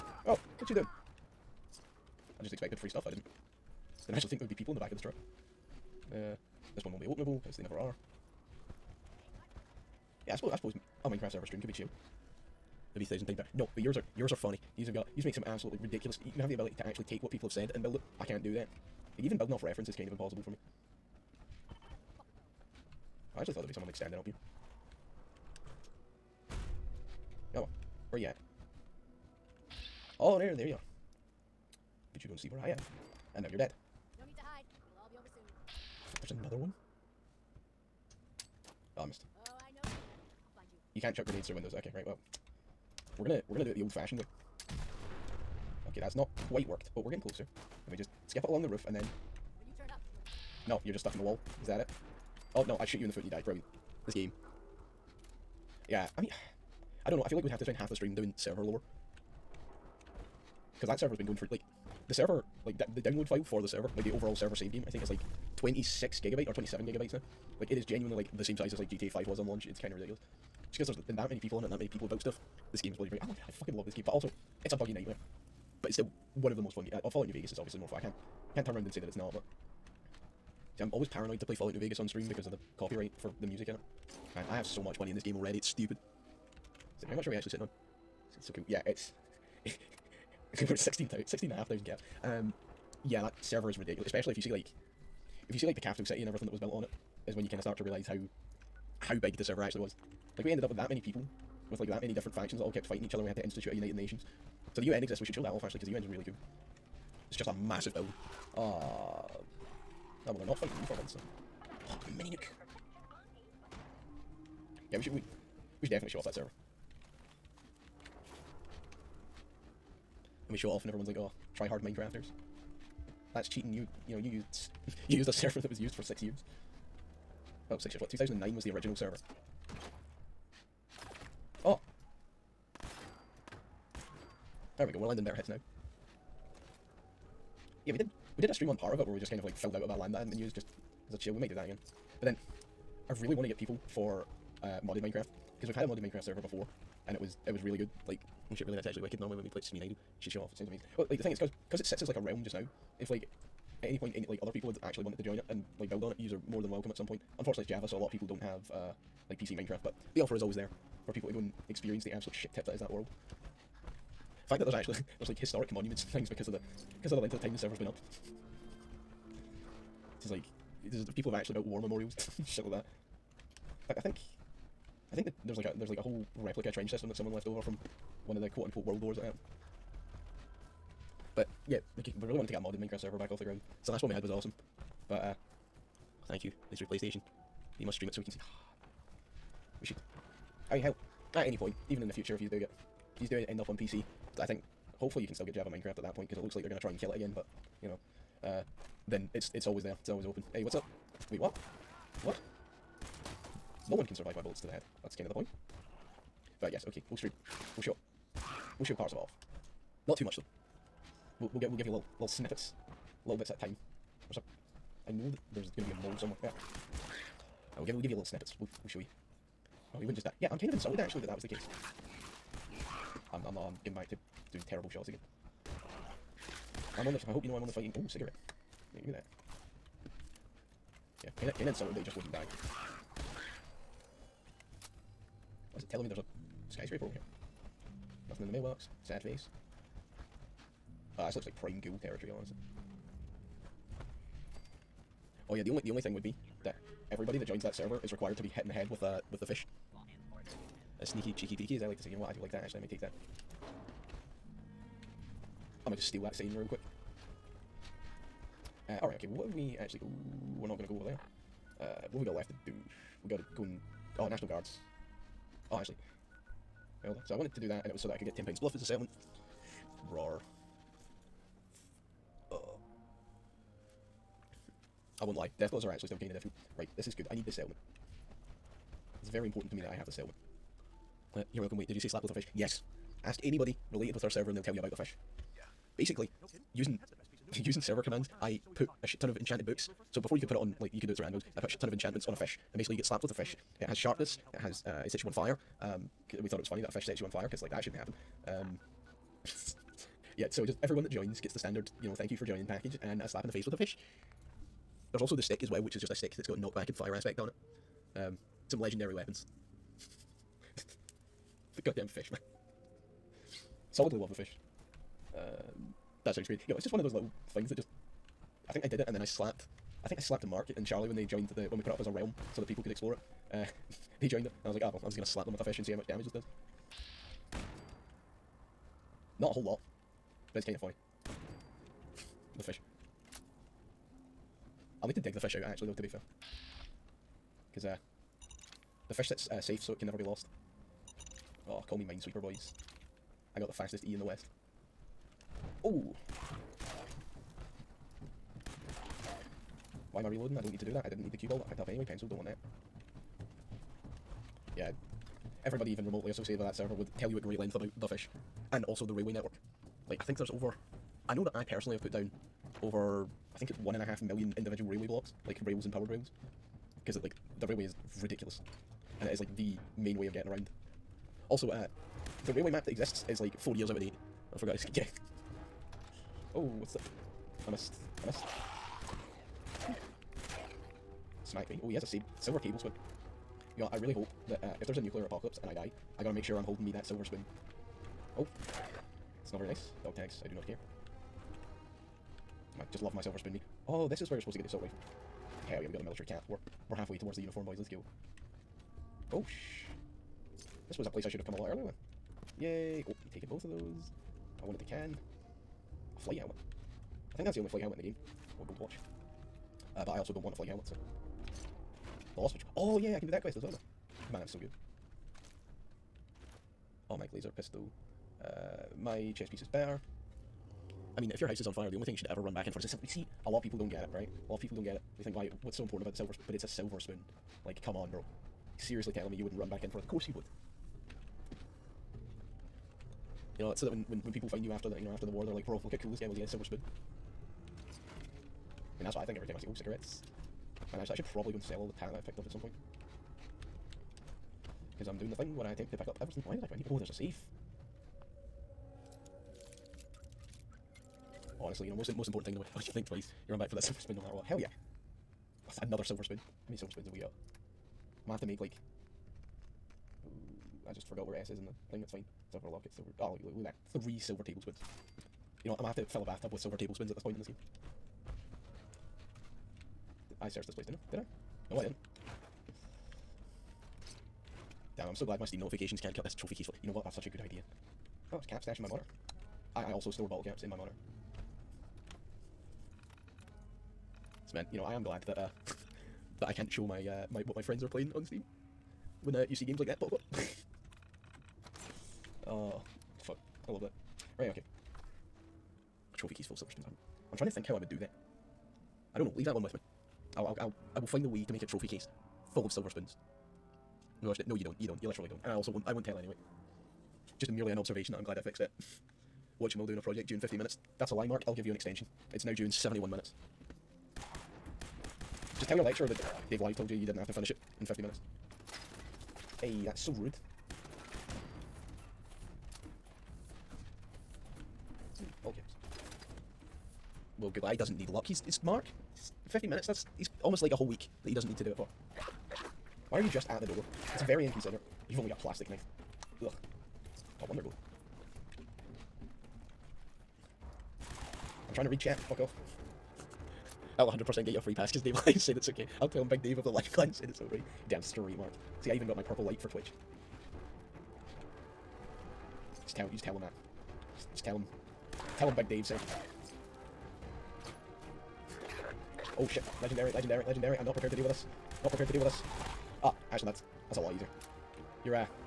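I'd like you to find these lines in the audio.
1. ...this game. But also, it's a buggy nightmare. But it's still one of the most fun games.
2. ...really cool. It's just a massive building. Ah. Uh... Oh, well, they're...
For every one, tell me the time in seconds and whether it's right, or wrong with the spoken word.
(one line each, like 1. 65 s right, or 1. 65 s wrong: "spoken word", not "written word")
1. 73 s right
2. 106 s right.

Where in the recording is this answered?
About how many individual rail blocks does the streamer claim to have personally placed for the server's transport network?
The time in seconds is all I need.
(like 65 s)
363 s.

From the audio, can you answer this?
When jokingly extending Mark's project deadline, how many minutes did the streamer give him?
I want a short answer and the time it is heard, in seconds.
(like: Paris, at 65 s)
71 minutes, at 512 s.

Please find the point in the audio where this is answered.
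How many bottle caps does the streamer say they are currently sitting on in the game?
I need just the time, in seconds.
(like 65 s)
90 s.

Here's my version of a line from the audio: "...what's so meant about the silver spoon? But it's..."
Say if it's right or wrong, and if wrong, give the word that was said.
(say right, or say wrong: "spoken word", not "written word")
wrong: "important", not "meant".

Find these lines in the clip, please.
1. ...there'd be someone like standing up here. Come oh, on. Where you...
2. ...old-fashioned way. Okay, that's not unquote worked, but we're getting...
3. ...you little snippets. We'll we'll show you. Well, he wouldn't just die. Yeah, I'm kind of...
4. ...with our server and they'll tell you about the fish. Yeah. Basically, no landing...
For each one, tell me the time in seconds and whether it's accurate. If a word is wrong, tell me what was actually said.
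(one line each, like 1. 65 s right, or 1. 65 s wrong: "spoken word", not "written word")
1. 23 s right
2. 43 s wrong: "quite", not "unquote"
3. 218 s right
4. 284 s wrong: "using", not "landing".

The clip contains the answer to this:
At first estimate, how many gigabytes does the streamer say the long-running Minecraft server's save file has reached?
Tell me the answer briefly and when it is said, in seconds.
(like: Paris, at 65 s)
26 gigabytes, at 65 s.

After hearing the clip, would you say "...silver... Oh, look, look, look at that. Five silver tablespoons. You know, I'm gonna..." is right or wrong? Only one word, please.
wrong.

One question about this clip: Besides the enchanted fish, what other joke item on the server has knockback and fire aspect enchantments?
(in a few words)
The stick.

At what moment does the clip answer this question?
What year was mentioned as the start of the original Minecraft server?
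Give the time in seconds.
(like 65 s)
128 s.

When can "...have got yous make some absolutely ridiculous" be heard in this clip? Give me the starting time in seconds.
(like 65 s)
14 s.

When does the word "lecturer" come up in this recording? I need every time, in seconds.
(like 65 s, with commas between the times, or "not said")
515 s.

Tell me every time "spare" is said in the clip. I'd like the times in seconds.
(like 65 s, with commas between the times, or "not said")
not said.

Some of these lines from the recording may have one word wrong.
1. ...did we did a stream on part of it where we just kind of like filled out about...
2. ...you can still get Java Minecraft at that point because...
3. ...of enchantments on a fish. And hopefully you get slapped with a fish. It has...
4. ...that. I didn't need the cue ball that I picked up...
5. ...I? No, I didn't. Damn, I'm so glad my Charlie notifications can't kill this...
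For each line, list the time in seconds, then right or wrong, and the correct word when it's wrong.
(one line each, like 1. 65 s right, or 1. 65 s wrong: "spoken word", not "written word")
1. 137 s right
2. 195 s right
3. 291 s wrong: "basically", not "hopefully"
4. 350 s right
5. 471 s wrong: "Steam", not "Charlie".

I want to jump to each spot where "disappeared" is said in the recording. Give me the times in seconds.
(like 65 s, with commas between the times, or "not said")
not said.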